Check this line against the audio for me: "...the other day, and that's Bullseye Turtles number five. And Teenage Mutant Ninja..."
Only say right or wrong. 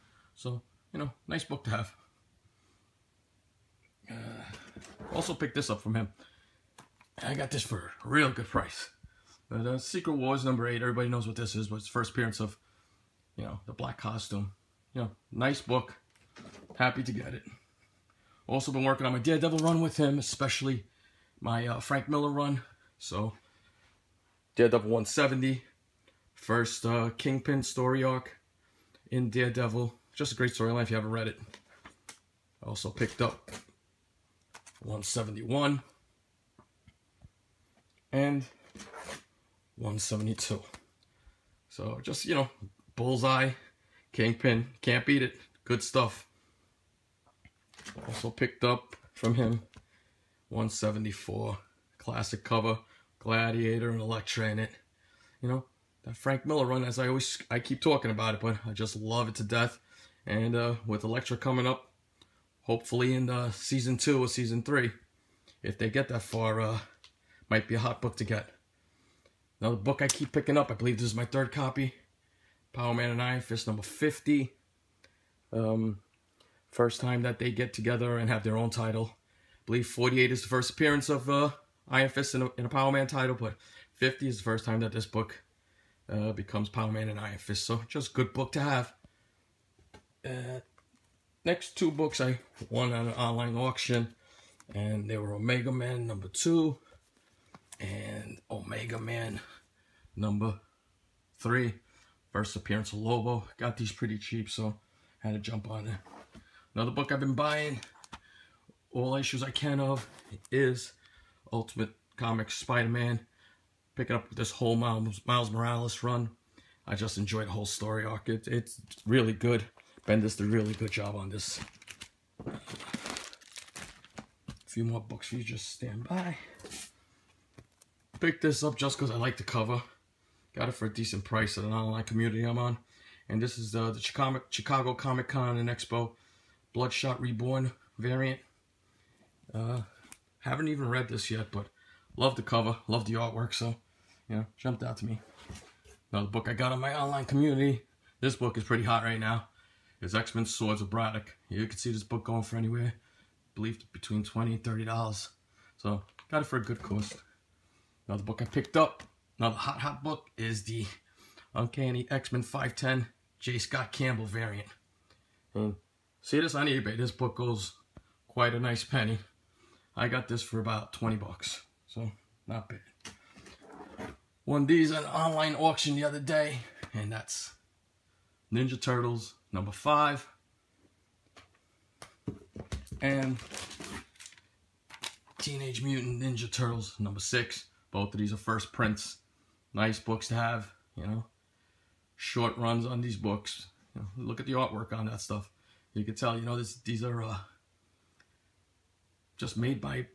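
wrong.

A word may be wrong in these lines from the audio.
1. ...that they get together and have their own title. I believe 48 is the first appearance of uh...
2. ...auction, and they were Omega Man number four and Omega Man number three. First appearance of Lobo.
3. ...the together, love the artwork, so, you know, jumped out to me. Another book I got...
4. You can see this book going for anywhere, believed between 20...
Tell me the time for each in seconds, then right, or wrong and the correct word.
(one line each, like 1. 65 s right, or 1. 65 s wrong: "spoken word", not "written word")
1. 77 s right
2. 93 s wrong: "two", not "four"
3. 142 s wrong: "cover", not "together"
4. 151 s right.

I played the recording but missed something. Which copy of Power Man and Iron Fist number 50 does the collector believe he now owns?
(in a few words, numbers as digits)
third.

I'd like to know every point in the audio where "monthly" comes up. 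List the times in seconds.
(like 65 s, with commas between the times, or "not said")
not said.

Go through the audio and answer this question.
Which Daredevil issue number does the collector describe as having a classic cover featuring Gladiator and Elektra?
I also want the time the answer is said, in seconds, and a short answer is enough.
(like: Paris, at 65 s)
174, at 50 s.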